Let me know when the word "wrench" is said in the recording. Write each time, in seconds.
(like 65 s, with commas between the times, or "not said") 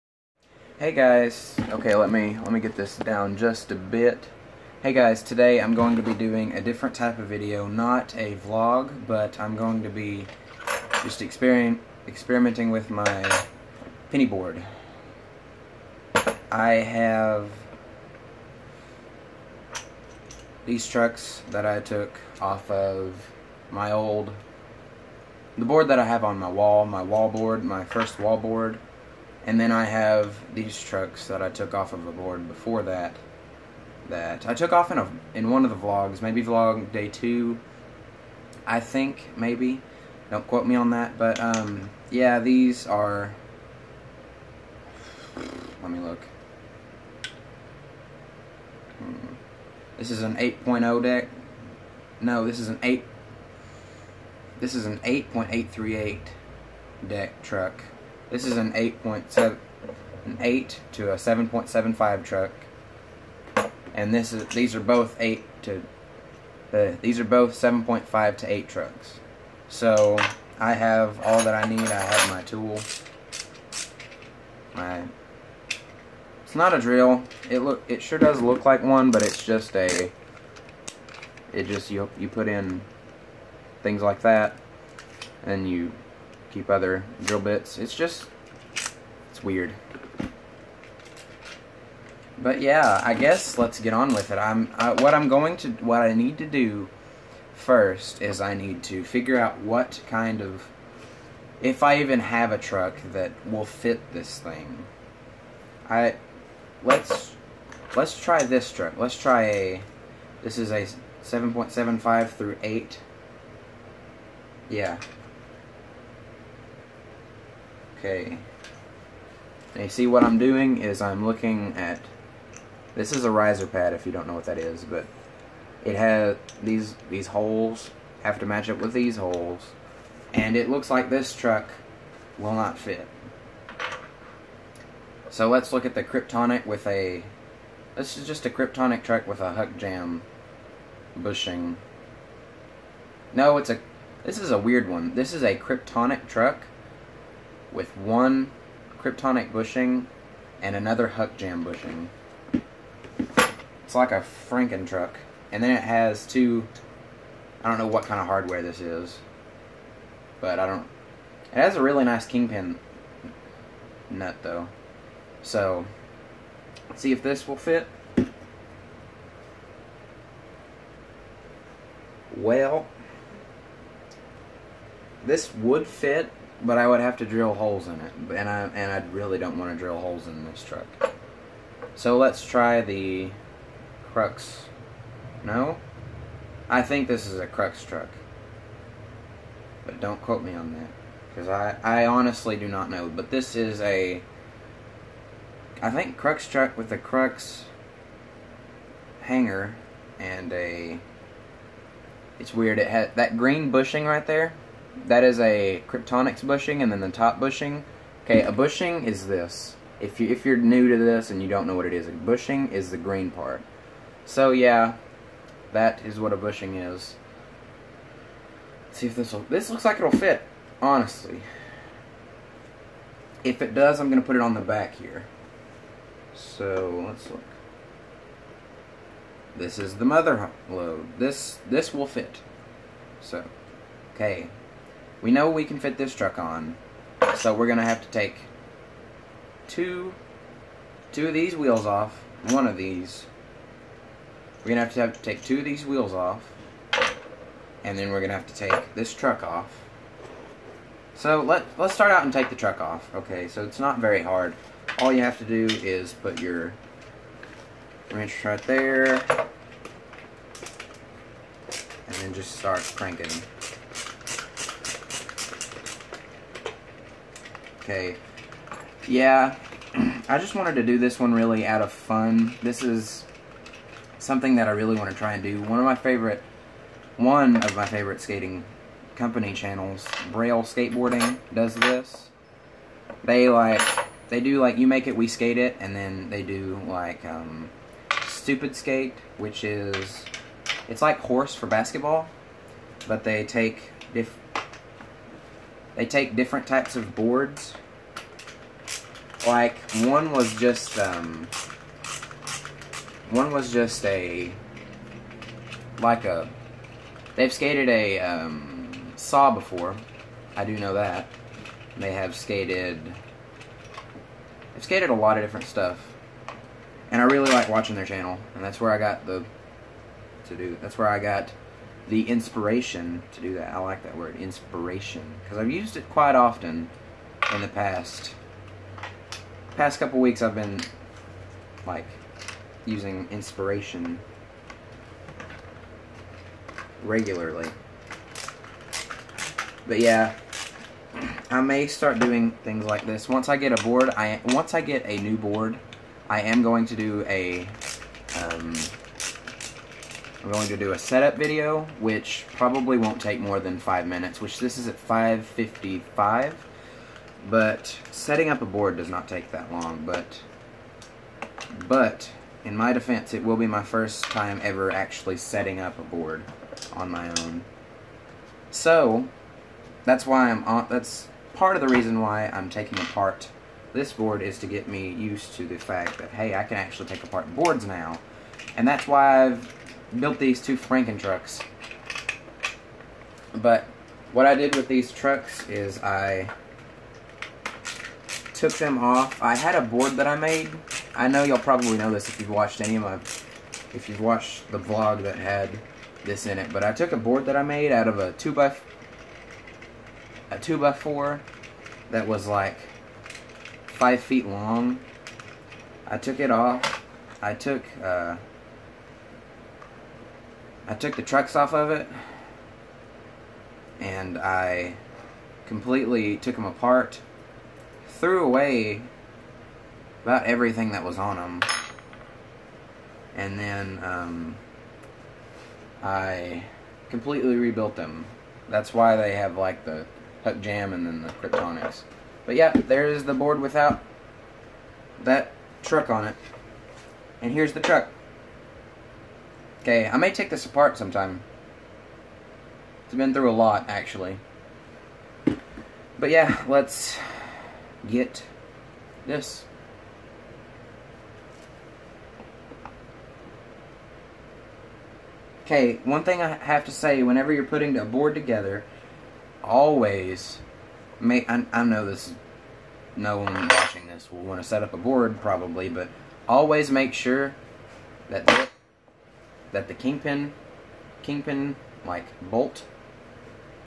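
258 s.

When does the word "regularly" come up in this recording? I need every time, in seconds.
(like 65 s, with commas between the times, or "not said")
337 s.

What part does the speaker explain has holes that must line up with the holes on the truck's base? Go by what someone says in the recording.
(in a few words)
Riser pad.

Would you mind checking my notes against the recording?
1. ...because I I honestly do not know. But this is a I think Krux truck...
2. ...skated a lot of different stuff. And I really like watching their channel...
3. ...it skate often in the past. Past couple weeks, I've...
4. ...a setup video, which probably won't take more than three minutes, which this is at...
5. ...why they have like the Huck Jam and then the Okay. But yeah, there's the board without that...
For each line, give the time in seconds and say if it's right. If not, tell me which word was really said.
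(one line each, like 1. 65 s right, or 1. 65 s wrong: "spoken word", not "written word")
1. 191 s right
2. 314 s right
3. 325 s wrong: "quite", not "skate"
4. 350 s wrong: "five", not "three"
5. 428 s wrong: "Kryptonics", not "Okay".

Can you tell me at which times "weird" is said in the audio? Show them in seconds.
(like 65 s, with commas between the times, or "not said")
89 s, 144 s, 202 s.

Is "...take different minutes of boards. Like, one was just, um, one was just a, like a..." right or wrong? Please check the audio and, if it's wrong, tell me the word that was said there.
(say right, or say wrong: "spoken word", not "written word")
wrong: "types", not "minutes".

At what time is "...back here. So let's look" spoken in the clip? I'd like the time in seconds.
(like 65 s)
224 s.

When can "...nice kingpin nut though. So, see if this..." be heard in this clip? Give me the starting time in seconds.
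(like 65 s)
162 s.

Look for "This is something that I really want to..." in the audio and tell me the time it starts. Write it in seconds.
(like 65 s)
272 s.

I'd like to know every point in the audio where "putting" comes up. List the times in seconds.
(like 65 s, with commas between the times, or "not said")
457 s.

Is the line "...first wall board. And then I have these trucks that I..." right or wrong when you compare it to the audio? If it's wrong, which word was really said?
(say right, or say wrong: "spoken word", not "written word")
right.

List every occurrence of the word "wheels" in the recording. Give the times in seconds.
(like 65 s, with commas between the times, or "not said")
241 s, 245 s.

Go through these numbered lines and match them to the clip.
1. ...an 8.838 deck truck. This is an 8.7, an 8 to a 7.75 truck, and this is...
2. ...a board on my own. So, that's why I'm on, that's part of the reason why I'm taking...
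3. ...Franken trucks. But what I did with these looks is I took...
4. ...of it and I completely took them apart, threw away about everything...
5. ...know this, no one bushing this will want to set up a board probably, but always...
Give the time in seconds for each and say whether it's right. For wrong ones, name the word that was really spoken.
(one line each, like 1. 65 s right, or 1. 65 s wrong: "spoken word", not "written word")
1. 54 s right
2. 365 s right
3. 380 s wrong: "trucks", not "looks"
4. 411 s right
5. 461 s wrong: "watching", not "bushing".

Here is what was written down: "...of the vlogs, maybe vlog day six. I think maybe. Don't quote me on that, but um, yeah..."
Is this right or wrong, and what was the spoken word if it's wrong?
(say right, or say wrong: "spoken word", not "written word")
wrong: "two", not "six".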